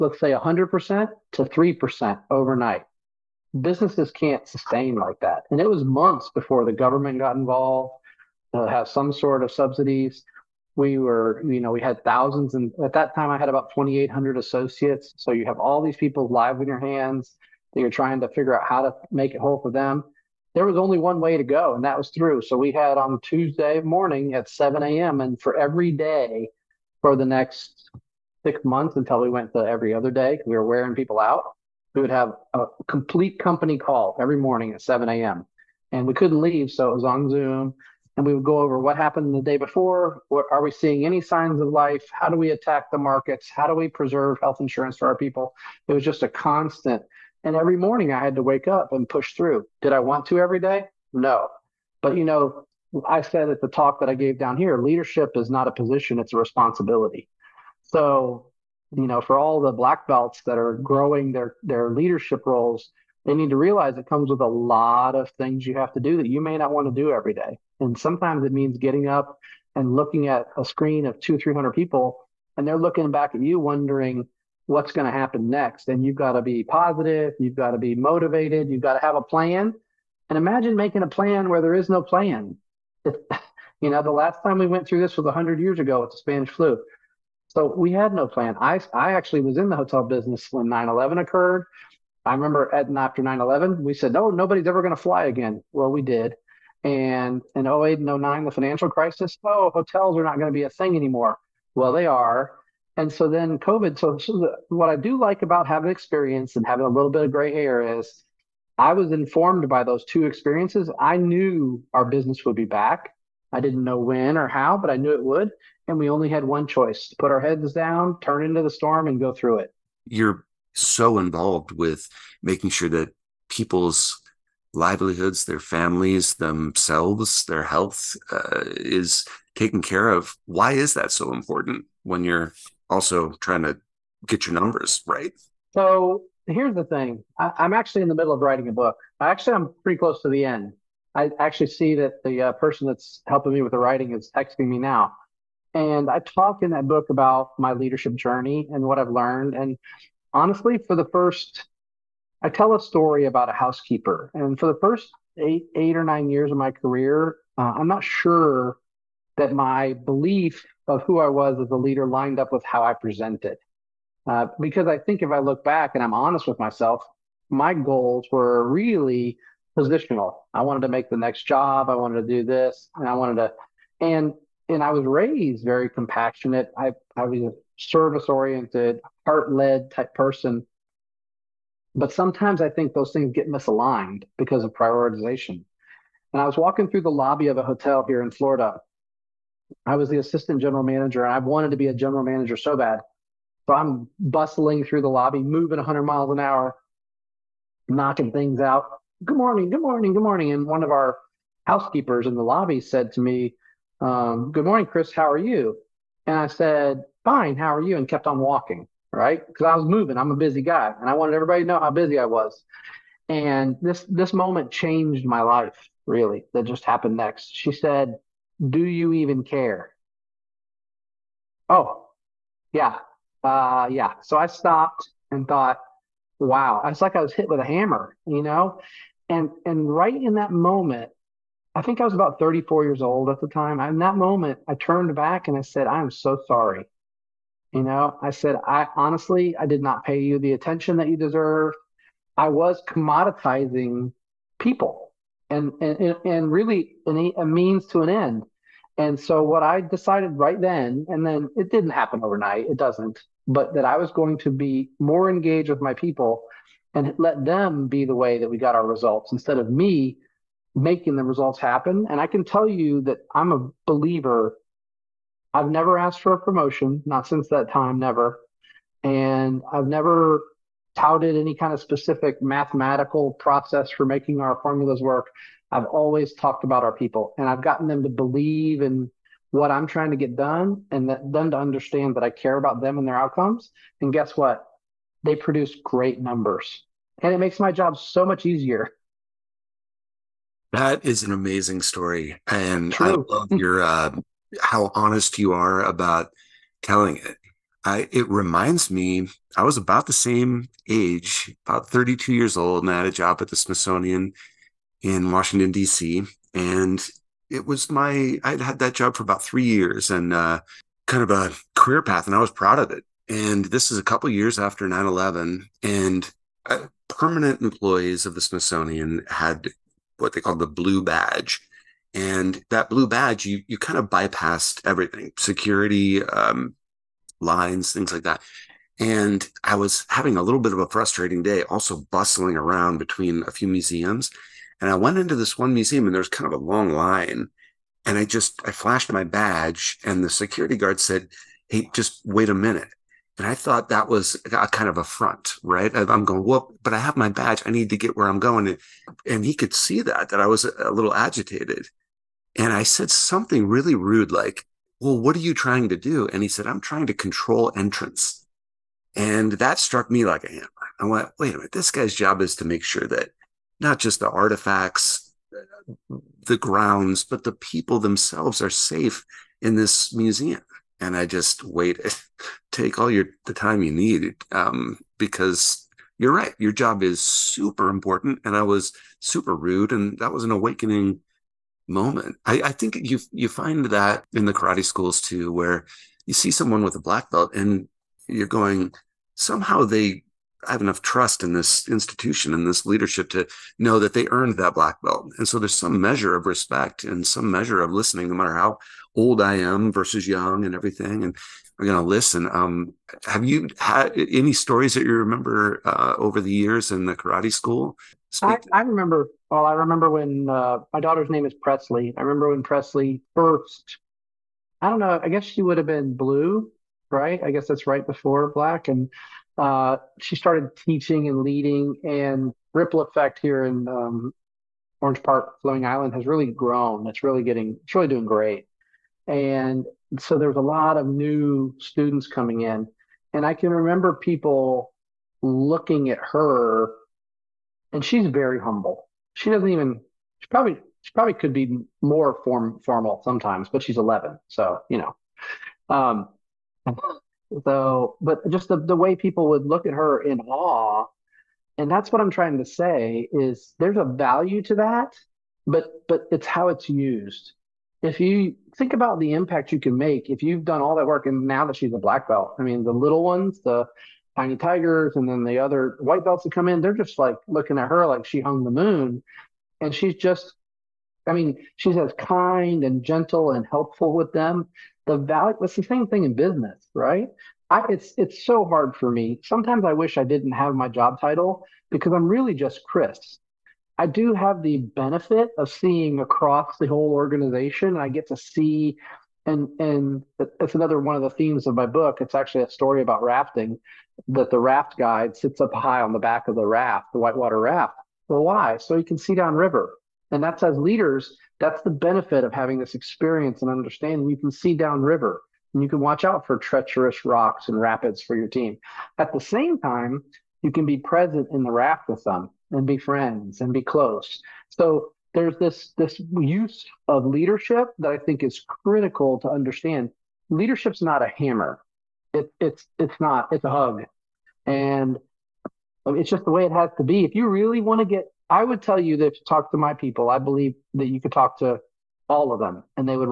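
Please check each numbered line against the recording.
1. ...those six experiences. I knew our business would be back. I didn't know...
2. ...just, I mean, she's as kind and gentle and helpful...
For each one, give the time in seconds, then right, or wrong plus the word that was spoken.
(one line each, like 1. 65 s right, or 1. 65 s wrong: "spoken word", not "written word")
1. 109 s wrong: "two", not "six"
2. 470 s right.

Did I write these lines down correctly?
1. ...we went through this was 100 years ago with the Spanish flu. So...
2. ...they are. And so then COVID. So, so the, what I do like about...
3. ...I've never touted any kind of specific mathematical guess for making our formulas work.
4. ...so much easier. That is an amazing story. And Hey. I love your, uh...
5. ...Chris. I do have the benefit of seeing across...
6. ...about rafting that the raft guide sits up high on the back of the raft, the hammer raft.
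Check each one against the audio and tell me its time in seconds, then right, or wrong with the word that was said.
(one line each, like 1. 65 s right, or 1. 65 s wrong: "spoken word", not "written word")
1. 84 s right
2. 101 s right
3. 269 s wrong: "process", not "guess"
4. 287 s wrong: "True", not "Hey"
5. 482 s right
6. 493 s wrong: "whitewater", not "hammer".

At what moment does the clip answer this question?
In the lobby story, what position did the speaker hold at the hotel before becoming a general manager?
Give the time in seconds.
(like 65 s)
190 s.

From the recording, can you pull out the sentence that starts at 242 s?
I was commoditizing people and and and really a means to an end.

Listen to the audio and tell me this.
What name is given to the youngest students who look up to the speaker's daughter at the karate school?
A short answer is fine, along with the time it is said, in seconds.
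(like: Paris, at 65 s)
Tiny Tigers, at 464 s.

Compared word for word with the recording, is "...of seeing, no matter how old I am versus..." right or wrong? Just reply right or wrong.
wrong.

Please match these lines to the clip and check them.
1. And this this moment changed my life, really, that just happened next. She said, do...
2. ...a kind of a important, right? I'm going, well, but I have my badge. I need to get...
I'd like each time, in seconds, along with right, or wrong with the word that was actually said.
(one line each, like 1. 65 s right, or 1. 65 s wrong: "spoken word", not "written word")
1. 213 s right
2. 344 s wrong: "front", not "important".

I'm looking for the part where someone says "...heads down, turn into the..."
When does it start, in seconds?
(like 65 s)
117 s.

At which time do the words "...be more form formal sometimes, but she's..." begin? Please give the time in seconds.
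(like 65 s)
441 s.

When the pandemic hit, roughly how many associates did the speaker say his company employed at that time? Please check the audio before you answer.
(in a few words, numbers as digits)
2,800.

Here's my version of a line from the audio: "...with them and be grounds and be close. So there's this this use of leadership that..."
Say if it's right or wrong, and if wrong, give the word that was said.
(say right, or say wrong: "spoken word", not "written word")
wrong: "friends", not "grounds".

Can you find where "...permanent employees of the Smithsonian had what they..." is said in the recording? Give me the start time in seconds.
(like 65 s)
317 s.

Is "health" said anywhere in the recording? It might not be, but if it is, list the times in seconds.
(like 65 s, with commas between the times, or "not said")
44 s, 127 s.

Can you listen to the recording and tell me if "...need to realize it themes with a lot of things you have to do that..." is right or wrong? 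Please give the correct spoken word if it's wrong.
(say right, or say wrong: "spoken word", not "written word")
wrong: "comes", not "themes".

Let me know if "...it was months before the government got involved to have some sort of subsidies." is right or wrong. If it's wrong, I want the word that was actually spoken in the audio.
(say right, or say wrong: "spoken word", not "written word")
right.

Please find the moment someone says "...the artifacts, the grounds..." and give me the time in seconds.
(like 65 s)
364 s.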